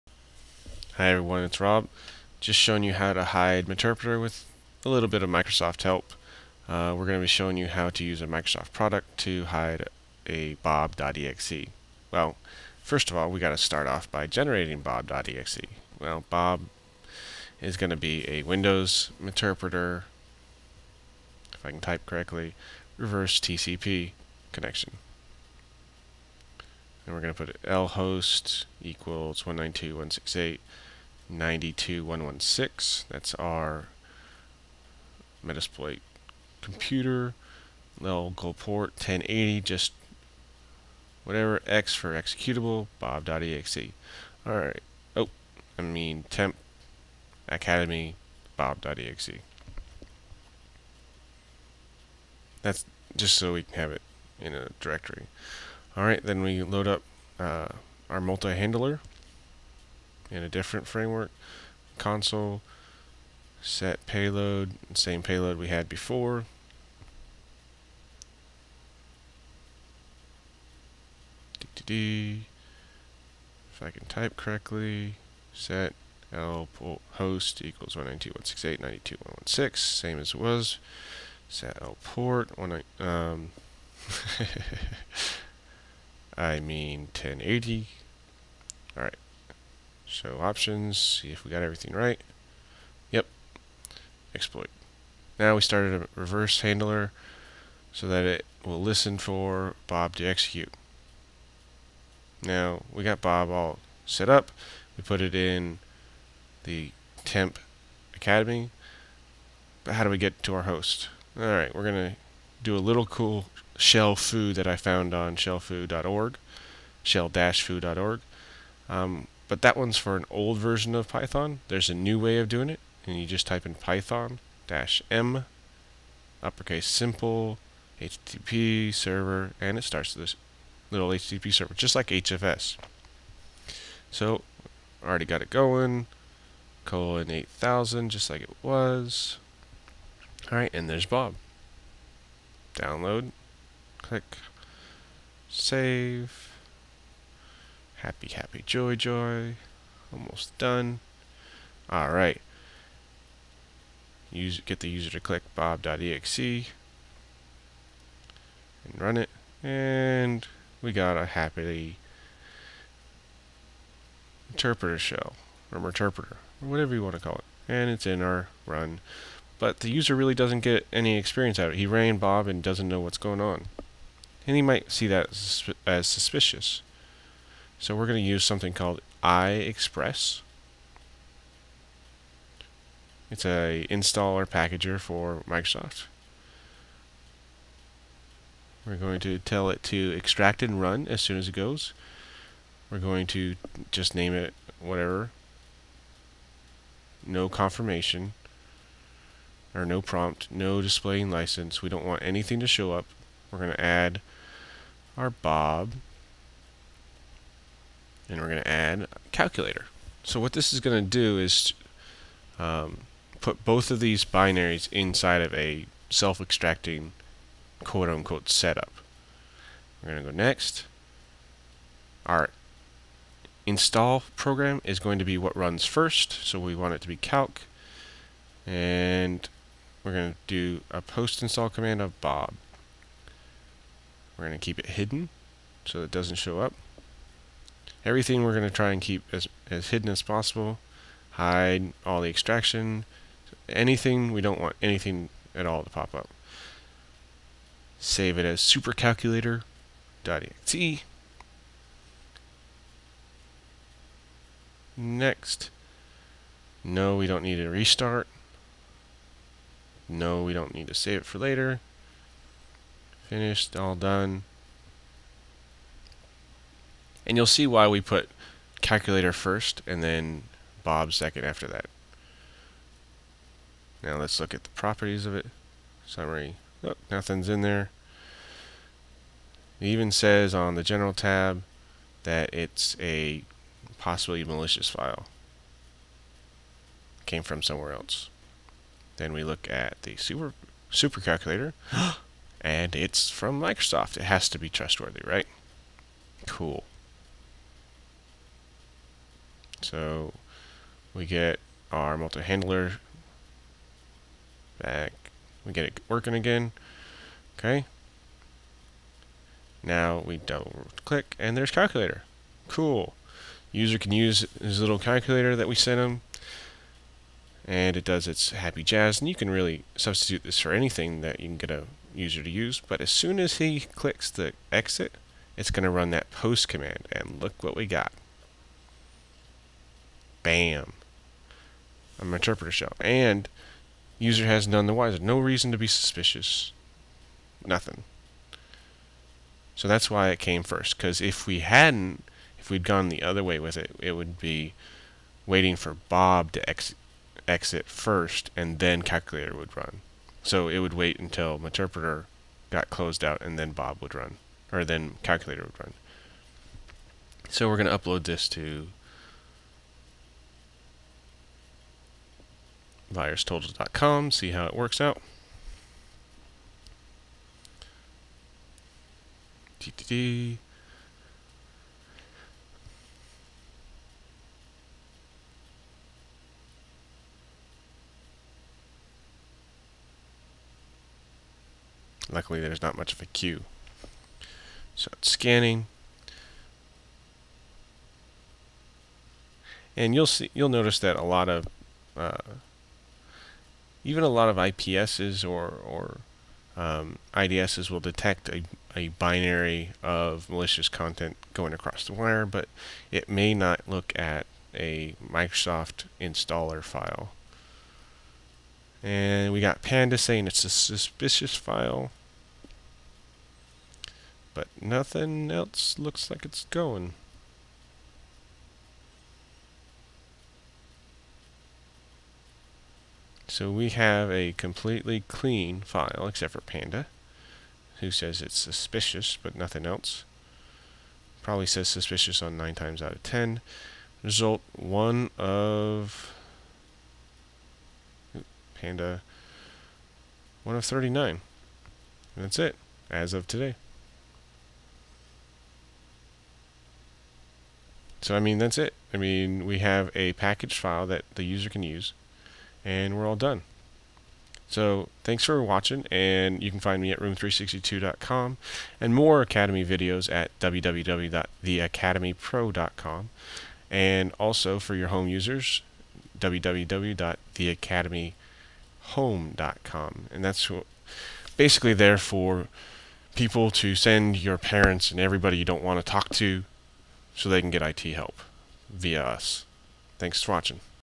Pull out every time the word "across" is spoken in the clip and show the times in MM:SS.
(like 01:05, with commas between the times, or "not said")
06:41.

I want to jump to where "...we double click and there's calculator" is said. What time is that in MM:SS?
05:10.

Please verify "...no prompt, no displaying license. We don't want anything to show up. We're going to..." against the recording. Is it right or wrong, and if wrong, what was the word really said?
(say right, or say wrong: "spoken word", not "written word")
right.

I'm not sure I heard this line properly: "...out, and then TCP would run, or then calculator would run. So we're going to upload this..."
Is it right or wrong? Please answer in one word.
wrong.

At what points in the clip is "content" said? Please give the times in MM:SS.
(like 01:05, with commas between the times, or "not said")
06:40.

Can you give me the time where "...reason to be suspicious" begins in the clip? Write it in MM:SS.
05:35.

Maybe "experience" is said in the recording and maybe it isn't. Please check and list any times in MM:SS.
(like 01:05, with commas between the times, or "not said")
02:51.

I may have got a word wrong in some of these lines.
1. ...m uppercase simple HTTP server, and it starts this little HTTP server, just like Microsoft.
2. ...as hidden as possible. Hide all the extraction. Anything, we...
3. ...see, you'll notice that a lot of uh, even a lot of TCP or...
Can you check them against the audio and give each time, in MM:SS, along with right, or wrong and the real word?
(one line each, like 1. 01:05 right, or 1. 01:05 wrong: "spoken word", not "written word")
1. 02:05 wrong: "HFS", not "Microsoft"
2. 03:59 right
3. 06:30 wrong: "IPSs", not "TCP".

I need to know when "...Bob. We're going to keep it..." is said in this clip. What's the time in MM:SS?
03:52.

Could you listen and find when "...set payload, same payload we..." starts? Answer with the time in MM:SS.
01:03.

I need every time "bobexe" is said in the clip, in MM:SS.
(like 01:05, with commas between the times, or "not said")
00:10, 00:14, 00:42, 00:48, 02:35.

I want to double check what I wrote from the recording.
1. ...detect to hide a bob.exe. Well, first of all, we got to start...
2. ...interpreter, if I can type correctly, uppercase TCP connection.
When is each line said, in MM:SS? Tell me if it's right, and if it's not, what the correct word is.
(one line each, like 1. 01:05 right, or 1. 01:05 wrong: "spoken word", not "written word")
1. 00:08 wrong: "product", not "detect"
2. 00:19 wrong: "reverse", not "uppercase".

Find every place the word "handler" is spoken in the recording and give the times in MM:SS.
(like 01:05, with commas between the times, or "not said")
00:58, 01:36, 05:02.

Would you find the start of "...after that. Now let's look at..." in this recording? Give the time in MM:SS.
04:31.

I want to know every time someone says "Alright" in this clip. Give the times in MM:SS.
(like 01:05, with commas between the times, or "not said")
00:44, 00:55, 01:28, 01:51.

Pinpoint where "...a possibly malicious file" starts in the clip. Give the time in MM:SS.
04:42.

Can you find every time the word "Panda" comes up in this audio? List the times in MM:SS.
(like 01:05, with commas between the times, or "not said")
06:49, 07:06, 07:18.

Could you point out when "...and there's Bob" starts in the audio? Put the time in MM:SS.
02:20.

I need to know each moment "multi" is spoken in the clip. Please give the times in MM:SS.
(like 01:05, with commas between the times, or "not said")
00:58, 05:02.